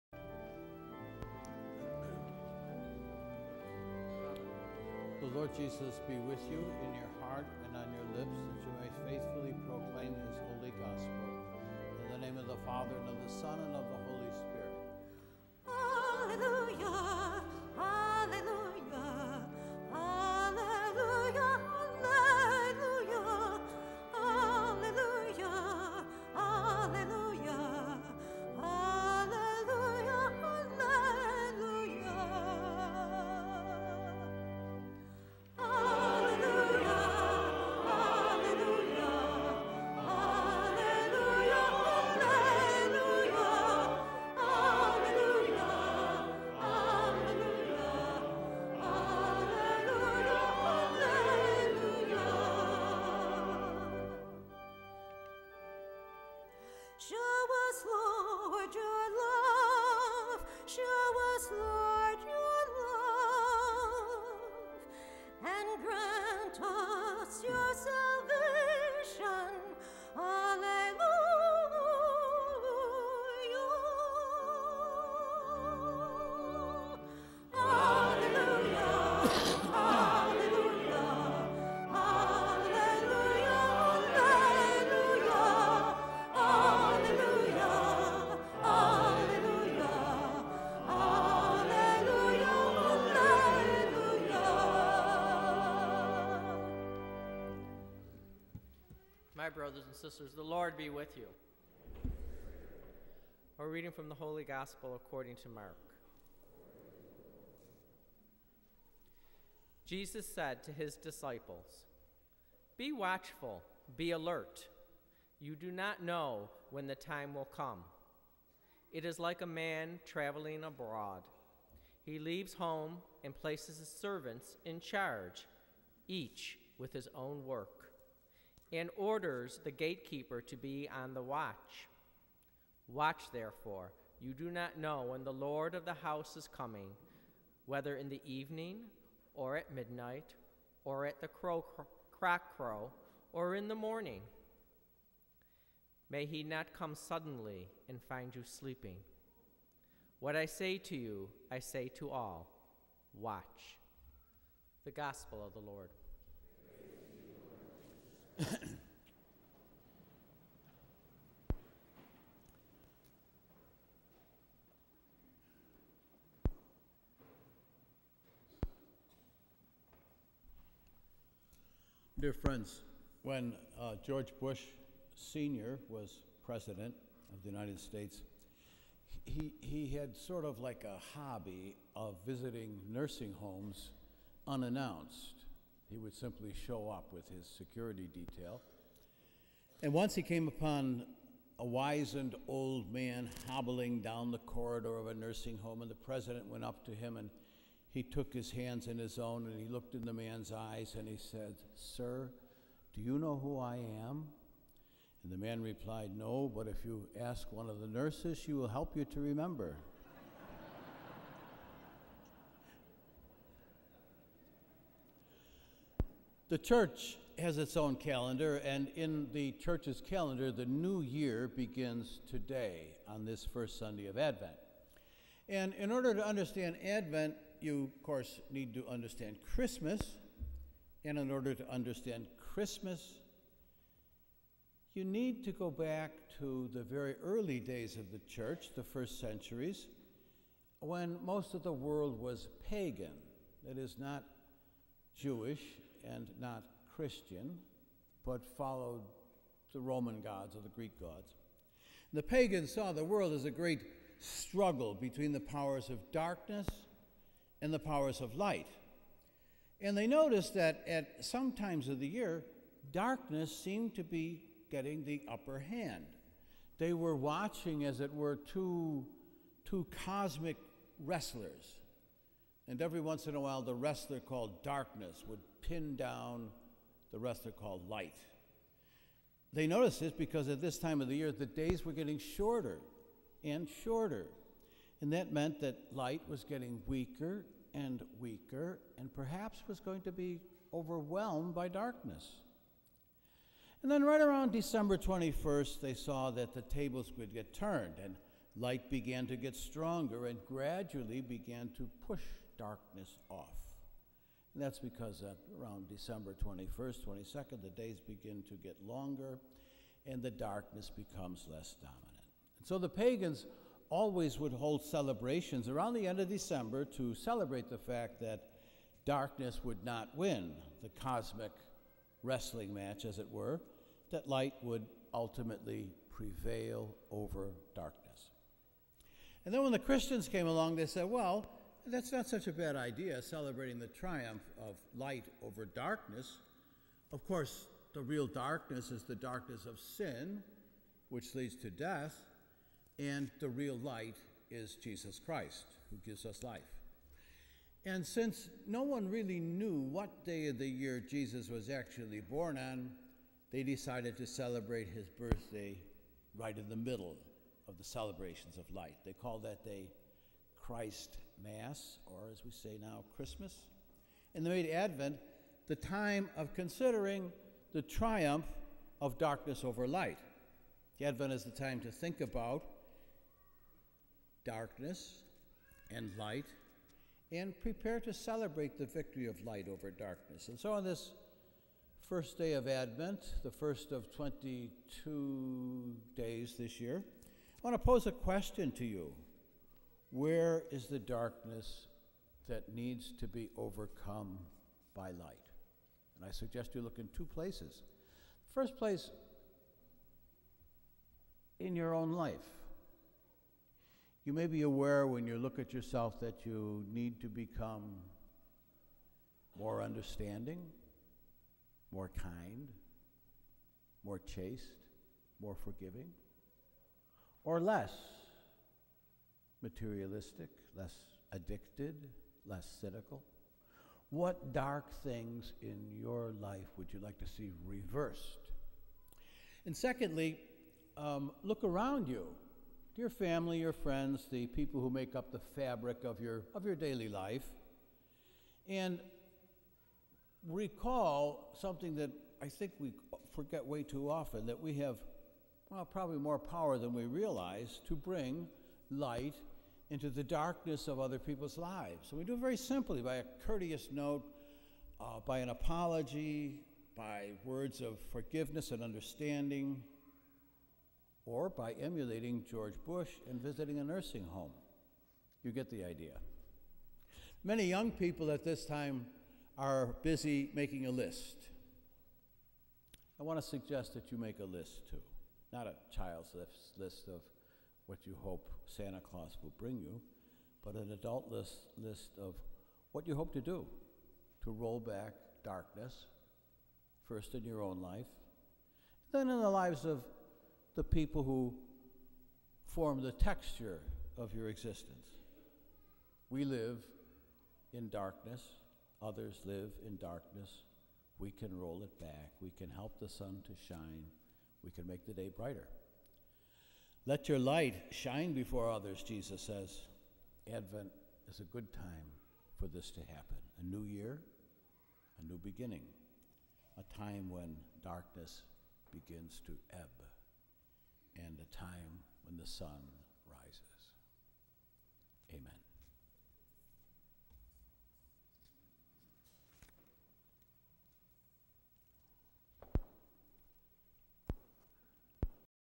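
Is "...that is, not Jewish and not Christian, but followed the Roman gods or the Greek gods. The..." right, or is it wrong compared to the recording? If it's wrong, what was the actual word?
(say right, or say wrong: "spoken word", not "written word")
right.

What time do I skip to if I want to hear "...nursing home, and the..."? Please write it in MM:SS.
03:15.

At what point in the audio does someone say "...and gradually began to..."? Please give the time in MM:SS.
05:00.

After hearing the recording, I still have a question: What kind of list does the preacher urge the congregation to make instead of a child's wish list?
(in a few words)
an adult list.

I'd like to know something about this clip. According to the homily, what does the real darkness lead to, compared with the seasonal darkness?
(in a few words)
death.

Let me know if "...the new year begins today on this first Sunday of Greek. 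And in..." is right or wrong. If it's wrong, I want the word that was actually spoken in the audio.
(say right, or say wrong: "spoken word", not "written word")
wrong: "Advent", not "Greek".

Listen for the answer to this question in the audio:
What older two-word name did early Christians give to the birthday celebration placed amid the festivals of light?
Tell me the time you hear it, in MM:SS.
06:00.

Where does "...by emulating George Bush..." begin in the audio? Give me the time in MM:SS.
07:41.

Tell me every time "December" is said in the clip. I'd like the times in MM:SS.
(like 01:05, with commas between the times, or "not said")
04:54, 05:05, 05:16.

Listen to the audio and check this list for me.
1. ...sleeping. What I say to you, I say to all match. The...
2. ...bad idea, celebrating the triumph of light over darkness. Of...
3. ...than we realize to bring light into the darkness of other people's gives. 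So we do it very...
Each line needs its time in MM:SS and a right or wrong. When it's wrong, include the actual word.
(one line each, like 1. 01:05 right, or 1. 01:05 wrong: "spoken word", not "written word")
1. 02:28 wrong: "watch", not "match"
2. 05:32 right
3. 07:26 wrong: "lives", not "gives".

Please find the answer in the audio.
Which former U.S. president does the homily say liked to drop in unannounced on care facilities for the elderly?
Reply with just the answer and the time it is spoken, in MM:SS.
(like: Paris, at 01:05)
George Bush Sr., at 02:54.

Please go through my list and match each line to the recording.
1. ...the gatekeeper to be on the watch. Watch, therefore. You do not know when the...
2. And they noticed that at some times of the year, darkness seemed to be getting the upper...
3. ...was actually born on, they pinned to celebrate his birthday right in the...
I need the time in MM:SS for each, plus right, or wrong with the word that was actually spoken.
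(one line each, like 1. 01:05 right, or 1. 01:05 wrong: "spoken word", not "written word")
1. 02:09 right
2. 04:19 right
3. 05:51 wrong: "decided", not "pinned".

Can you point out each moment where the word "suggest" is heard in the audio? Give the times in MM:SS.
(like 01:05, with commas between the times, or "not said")
06:36, 07:53.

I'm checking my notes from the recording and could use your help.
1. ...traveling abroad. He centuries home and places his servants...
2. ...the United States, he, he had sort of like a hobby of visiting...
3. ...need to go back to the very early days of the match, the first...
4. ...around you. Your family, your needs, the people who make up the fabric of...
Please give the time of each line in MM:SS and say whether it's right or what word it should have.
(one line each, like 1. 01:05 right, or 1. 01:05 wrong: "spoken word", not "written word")
1. 02:00 wrong: "leaves", not "centuries"
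2. 02:57 right
3. 03:55 wrong: "church", not "match"
4. 07:11 wrong: "friends", not "needs".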